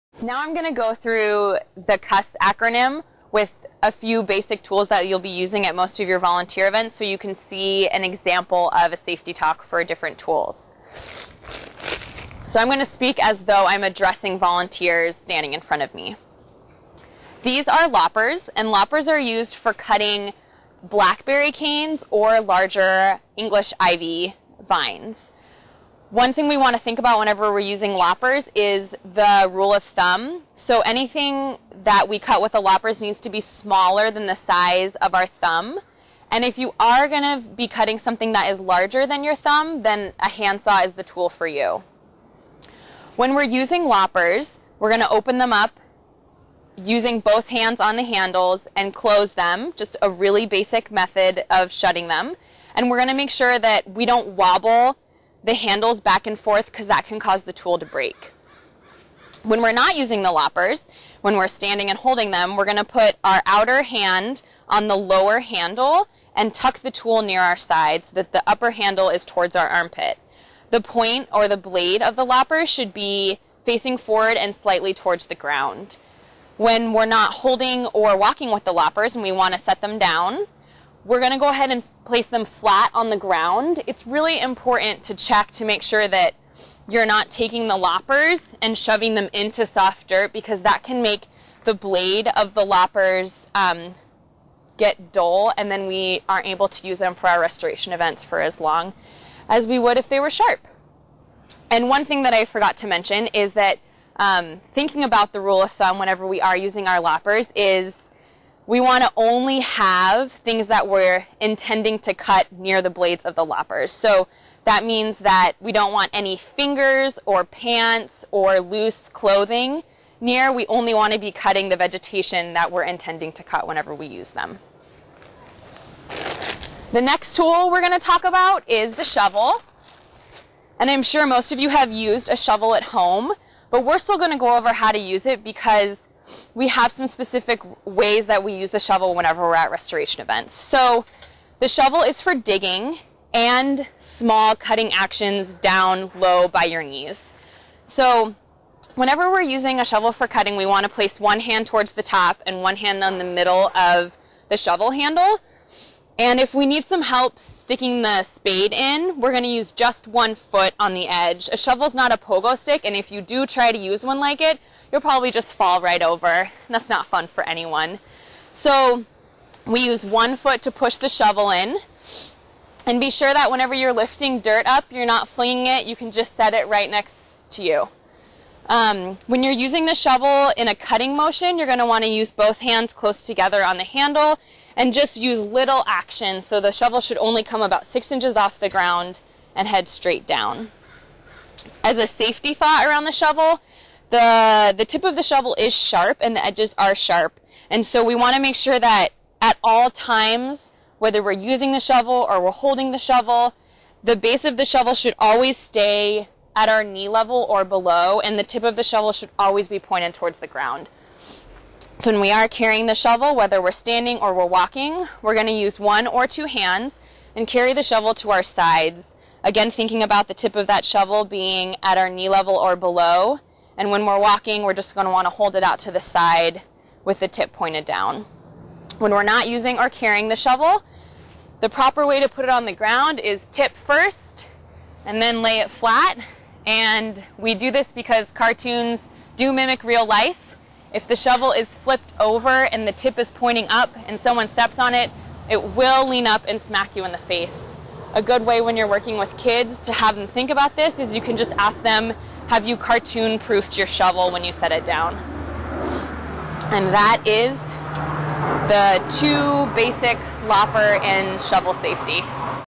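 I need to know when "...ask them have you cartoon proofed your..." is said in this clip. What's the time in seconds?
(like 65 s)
251 s.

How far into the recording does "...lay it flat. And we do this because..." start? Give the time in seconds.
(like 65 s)
235 s.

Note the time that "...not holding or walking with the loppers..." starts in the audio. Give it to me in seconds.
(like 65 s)
77 s.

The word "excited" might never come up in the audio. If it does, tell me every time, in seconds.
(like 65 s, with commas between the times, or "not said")
not said.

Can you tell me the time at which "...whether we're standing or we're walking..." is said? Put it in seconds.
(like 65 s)
213 s.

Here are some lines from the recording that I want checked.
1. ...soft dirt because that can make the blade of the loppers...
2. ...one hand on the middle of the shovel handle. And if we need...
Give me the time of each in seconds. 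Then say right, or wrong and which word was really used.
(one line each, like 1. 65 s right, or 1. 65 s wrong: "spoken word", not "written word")
1. 89 s right
2. 152 s right.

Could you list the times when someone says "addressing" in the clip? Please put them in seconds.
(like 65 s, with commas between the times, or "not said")
13 s.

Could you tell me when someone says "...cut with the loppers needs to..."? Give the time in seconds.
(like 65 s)
32 s.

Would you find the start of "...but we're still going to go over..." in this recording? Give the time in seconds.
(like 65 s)
133 s.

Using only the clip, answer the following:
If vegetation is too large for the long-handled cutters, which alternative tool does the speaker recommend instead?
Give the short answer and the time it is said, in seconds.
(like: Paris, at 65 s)
Handsaw, at 40 s.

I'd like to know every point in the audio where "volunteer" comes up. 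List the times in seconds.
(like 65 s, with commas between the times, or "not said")
6 s, 14 s.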